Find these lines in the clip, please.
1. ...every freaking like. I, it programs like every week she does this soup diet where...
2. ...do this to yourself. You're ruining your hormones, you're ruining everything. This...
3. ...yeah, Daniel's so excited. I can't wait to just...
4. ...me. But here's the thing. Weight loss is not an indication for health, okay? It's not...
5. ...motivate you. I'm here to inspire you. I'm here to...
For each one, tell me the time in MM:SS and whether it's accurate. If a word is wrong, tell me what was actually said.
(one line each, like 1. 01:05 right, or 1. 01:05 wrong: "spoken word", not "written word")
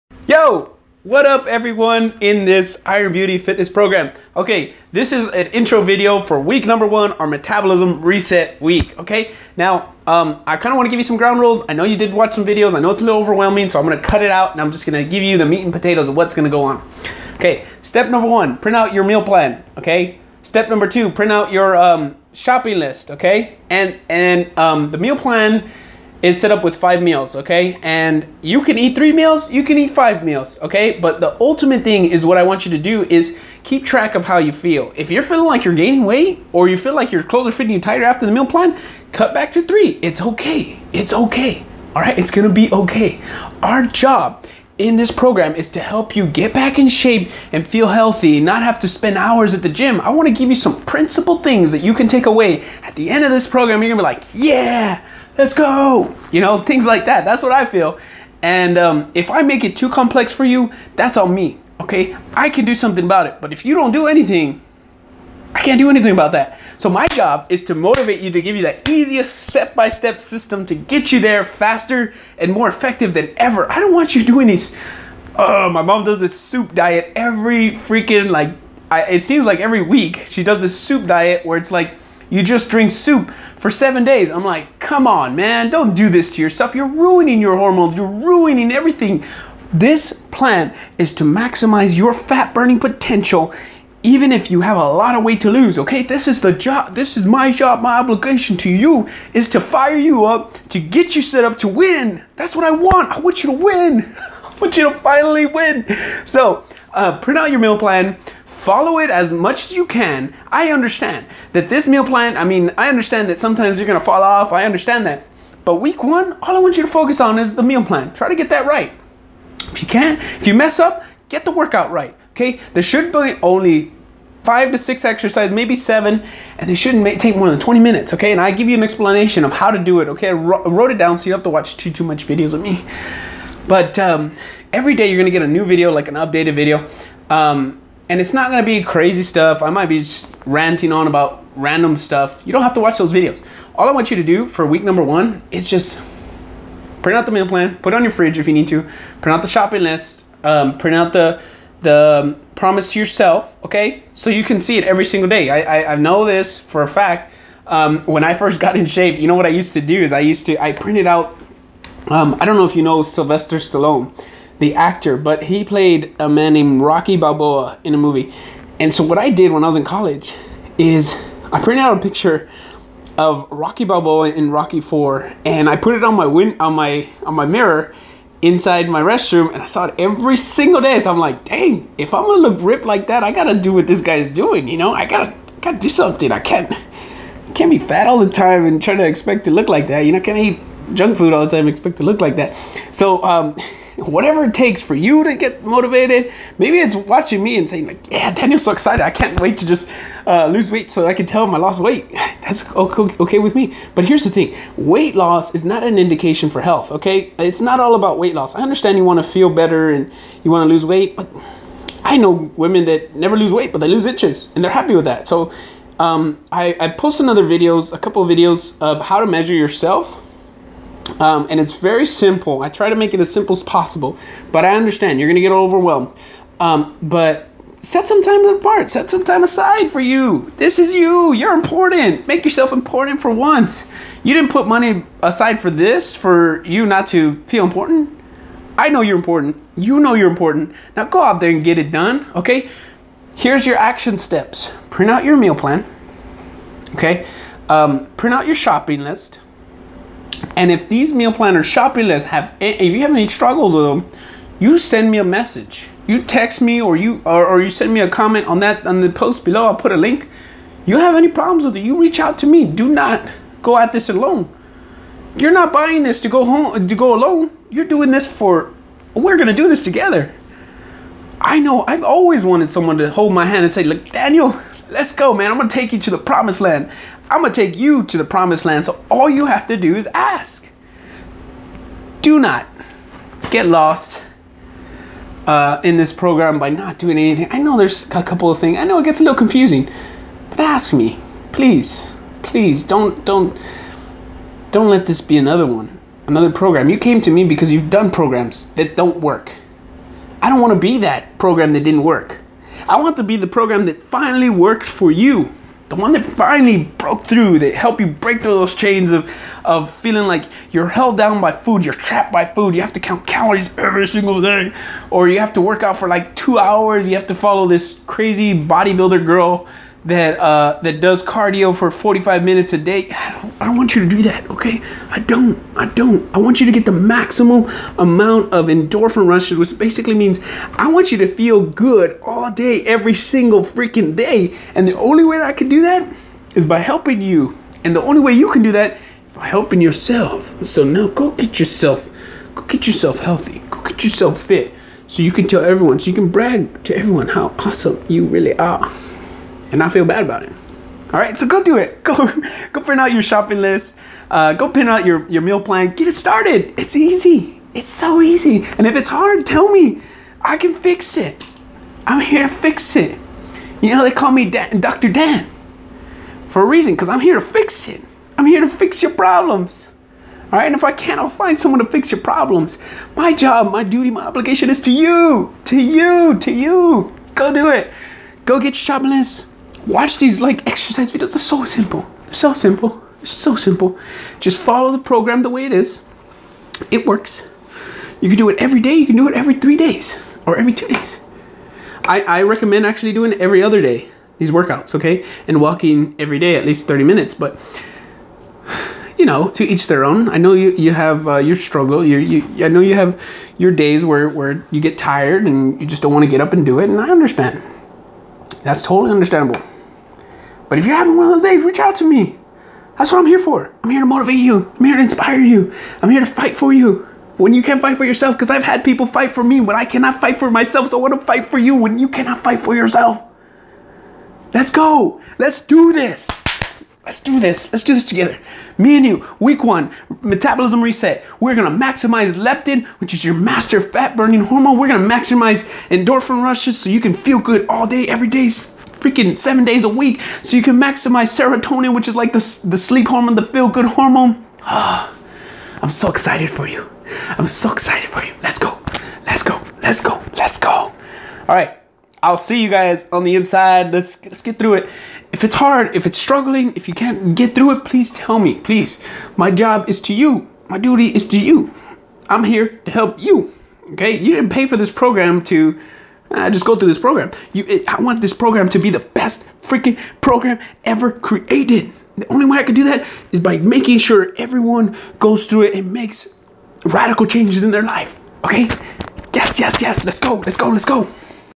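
1. 01:17 wrong: "seems", not "programs"
2. 01:25 right
3. 03:18 right
4. 03:23 right
5. 06:54 right.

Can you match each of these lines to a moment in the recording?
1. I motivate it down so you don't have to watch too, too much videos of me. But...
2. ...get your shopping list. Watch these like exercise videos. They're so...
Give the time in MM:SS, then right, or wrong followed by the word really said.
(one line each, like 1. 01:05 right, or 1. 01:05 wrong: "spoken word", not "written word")
1. 02:10 wrong: "wrote", not "motivate"
2. 06:18 right.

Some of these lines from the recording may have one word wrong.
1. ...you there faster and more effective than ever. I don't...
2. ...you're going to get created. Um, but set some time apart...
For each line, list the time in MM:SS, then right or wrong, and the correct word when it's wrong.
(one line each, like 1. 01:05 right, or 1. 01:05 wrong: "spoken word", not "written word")
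1. 01:11 right
2. 03:45 wrong: "overwhelmed", not "created".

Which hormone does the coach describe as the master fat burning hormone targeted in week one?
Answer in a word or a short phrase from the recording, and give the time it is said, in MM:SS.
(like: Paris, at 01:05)
Leptin, at 07:12.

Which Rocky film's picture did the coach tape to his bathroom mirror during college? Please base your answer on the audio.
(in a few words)
Rocky 4.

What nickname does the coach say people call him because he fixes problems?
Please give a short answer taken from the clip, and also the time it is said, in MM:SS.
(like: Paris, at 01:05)
Dr. Dan, at 06:04.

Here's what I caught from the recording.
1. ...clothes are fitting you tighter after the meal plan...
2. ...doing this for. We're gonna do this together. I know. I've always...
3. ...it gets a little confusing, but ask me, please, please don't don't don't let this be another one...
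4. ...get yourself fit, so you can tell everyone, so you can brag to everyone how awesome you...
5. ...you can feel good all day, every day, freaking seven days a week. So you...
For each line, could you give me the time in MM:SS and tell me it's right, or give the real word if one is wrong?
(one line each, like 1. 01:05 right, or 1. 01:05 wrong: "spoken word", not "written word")
1. 00:37 right
2. 04:27 right
3. 04:48 right
4. 05:43 right
5. 07:16 right.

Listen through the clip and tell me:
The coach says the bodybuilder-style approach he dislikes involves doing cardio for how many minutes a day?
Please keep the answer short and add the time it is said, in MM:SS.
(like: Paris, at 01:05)
45, at 05:21.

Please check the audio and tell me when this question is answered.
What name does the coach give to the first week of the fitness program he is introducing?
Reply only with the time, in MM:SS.
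00:07.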